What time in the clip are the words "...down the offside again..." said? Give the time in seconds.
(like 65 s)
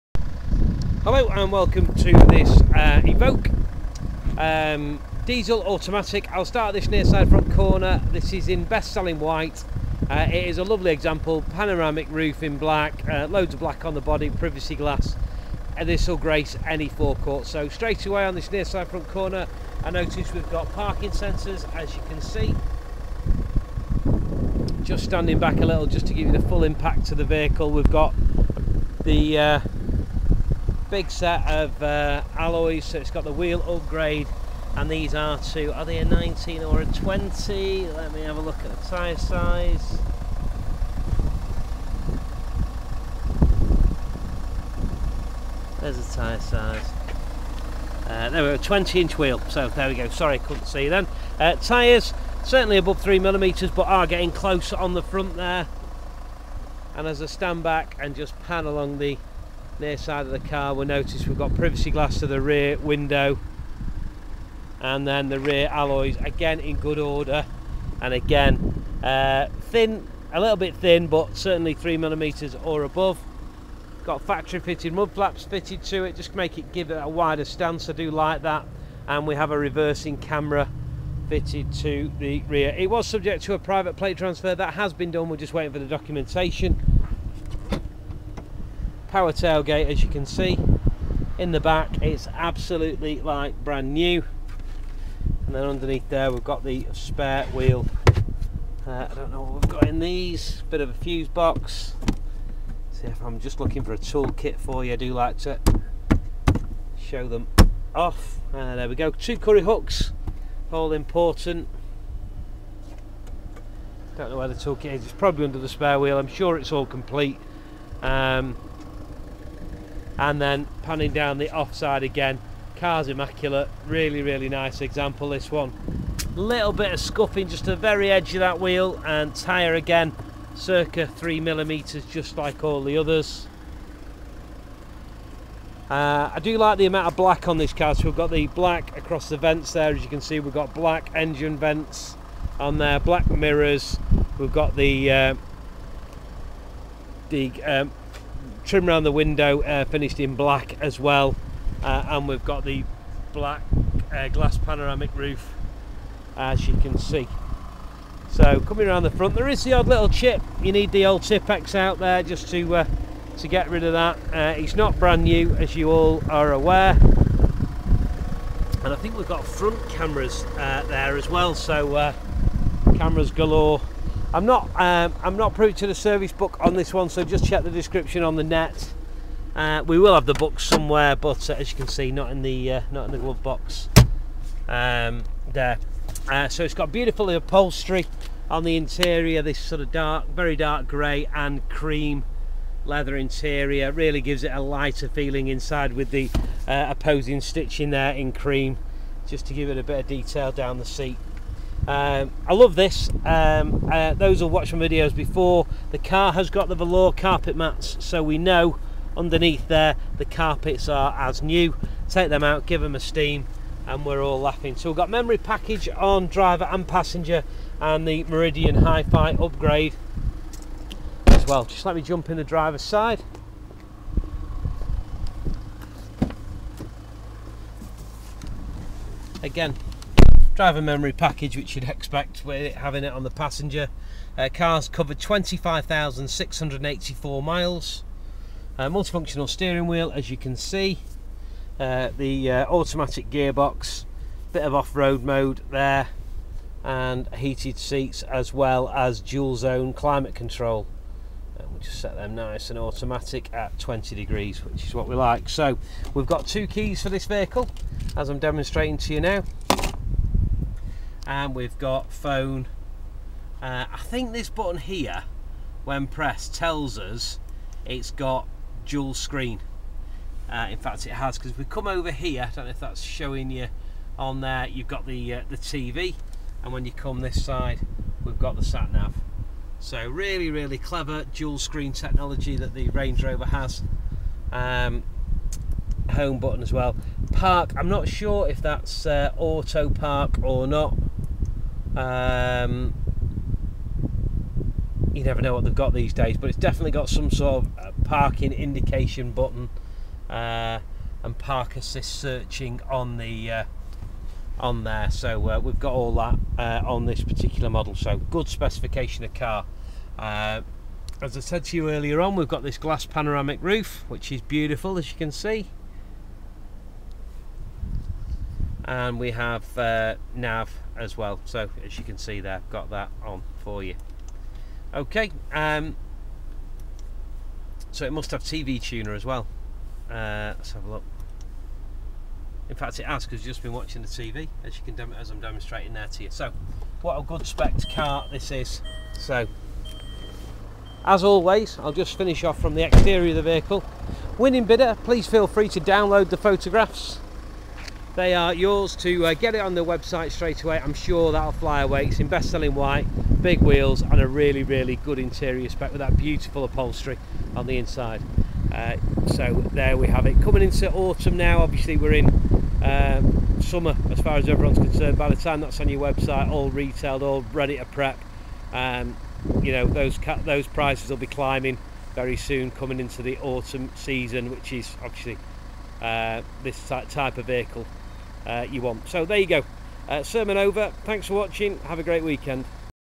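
121 s.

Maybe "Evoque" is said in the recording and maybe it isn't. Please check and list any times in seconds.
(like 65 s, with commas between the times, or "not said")
3 s.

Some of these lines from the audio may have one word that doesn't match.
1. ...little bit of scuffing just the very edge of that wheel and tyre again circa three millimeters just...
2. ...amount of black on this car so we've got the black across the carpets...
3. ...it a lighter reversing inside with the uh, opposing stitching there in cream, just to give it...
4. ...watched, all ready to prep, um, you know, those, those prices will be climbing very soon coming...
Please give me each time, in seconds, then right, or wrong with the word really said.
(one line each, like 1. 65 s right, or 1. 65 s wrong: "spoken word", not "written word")
1. 126 s right
2. 136 s wrong: "vents", not "carpets"
3. 194 s wrong: "feeling", not "reversing"
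4. 366 s wrong: "retailed", not "watched".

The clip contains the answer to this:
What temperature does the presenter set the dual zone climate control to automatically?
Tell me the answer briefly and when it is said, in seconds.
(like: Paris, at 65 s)
20 degrees, at 253 s.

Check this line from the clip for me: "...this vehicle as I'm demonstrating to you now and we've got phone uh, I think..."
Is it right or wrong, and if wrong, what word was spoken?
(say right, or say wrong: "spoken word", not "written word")
right.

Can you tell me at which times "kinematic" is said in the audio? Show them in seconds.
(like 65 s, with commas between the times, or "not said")
not said.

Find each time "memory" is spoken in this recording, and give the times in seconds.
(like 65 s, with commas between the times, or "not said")
215 s, 230 s.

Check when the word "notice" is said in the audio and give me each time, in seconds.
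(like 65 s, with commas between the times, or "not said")
19 s, 60 s.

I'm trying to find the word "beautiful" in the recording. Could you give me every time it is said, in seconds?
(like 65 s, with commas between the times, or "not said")
186 s, 314 s, 356 s.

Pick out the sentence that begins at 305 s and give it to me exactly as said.
So uh, we've got all that uh, on this particular model.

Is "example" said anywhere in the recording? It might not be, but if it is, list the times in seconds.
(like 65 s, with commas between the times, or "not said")
10 s, 124 s.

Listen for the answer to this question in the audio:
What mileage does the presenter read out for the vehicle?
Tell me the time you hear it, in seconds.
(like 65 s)
235 s.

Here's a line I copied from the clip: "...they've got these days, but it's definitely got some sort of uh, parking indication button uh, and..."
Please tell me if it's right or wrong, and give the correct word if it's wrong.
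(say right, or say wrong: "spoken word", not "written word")
right.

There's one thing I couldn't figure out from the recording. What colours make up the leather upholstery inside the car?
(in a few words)
dark grey and cream.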